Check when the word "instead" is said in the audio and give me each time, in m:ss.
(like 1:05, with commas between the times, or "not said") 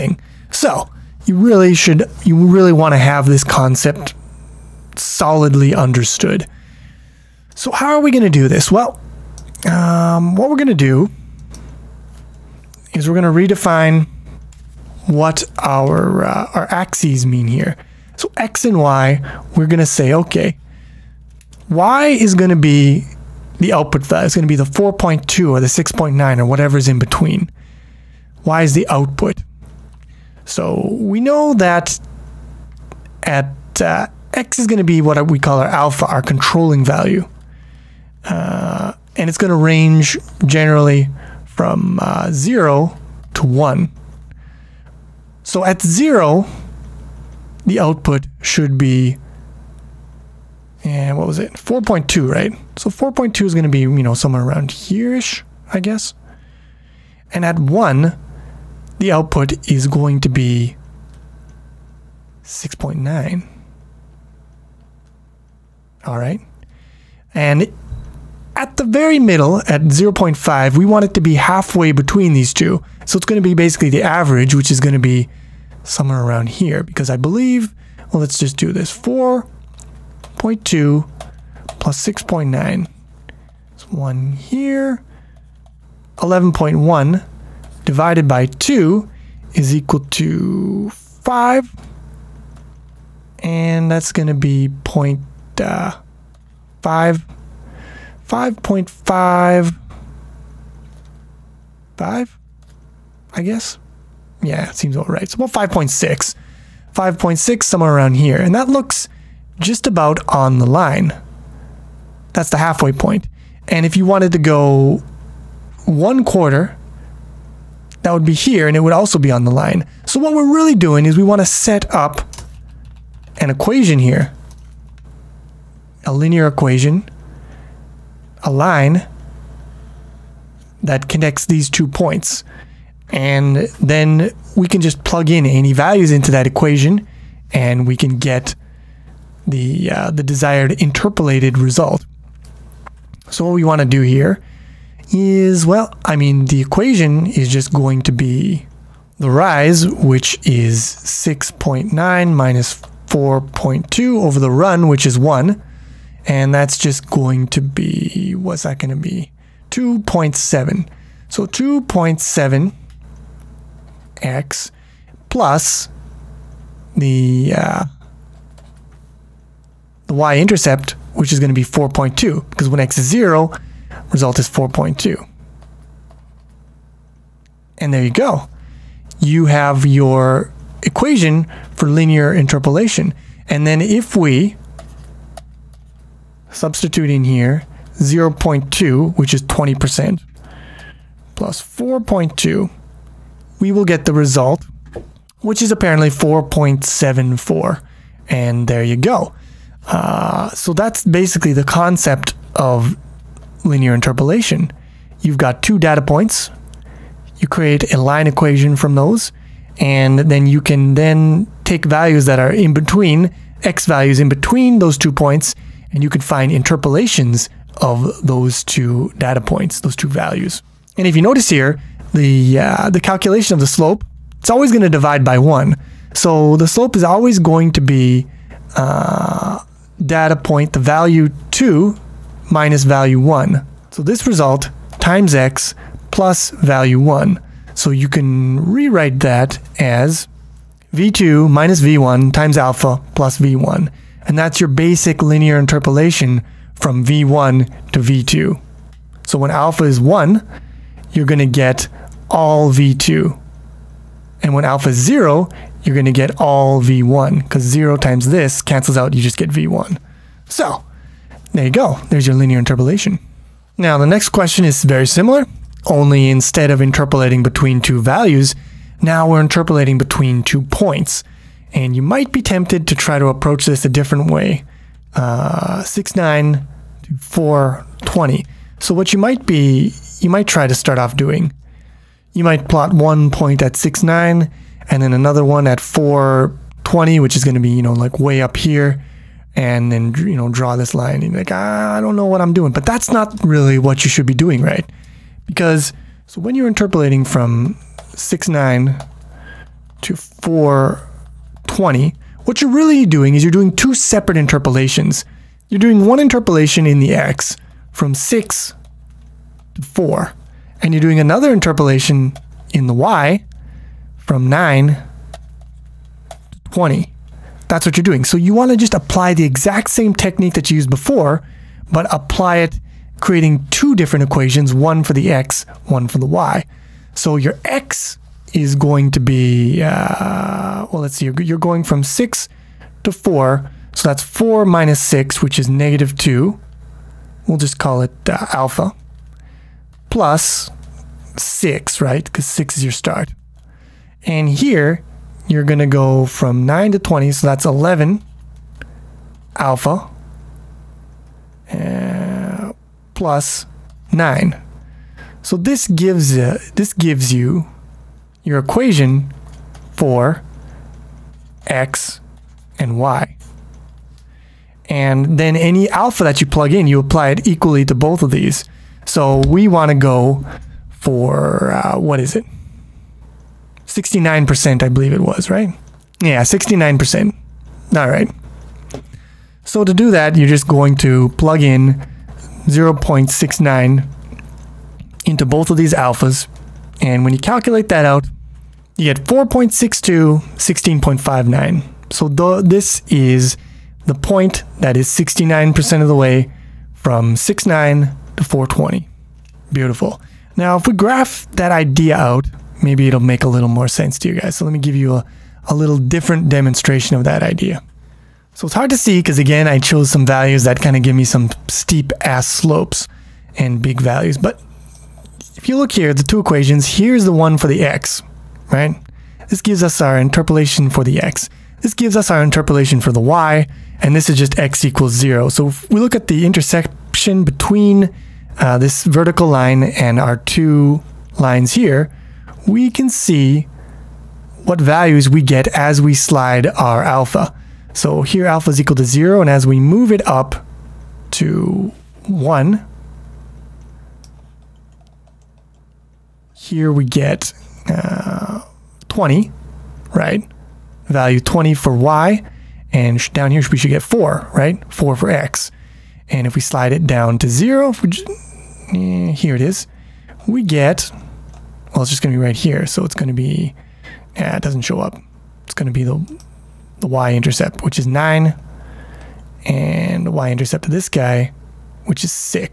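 4:26.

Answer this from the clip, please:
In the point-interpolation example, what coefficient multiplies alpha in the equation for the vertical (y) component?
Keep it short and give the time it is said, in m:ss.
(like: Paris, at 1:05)
11, at 5:47.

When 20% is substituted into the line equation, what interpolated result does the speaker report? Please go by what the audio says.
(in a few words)
4.74.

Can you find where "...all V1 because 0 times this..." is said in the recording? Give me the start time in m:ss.
4:16.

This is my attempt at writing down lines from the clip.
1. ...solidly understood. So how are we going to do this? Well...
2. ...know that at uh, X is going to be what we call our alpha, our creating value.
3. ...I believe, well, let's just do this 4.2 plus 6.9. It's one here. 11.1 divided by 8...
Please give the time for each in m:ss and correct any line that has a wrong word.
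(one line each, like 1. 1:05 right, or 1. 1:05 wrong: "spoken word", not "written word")
1. 0:04 right
2. 0:31 wrong: "controlling", not "creating"
3. 1:17 wrong: "2", not "8".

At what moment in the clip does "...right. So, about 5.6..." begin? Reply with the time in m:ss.
1:45.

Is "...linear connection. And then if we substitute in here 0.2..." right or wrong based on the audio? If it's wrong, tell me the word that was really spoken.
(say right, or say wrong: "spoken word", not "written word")
wrong: "interpolation", not "connection".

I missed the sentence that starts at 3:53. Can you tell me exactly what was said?
So this result times x plus value 1.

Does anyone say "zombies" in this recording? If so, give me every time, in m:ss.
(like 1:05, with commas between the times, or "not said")
not said.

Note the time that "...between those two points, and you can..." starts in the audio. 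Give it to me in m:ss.
3:34.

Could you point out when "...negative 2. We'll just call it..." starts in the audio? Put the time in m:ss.
5:35.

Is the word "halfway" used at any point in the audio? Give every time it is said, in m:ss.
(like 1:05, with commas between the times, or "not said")
1:11, 1:52.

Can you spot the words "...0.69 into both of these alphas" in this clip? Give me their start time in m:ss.
6:22.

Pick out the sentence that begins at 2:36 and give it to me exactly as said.
And that's just going to be, what's that going to be?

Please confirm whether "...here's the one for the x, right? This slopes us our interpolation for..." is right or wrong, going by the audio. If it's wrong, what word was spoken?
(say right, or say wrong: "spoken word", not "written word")
wrong: "gives", not "slopes".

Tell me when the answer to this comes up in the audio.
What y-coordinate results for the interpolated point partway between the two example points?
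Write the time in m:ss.
6:30.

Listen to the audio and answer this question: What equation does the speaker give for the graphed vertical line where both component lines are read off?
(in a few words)
x equals zero.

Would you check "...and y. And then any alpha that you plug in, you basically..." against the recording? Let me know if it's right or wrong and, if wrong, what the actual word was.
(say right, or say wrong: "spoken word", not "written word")
wrong: "apply", not "basically".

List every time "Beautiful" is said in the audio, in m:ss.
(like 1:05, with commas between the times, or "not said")
6:39.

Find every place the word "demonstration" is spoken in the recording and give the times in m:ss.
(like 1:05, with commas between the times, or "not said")
6:46.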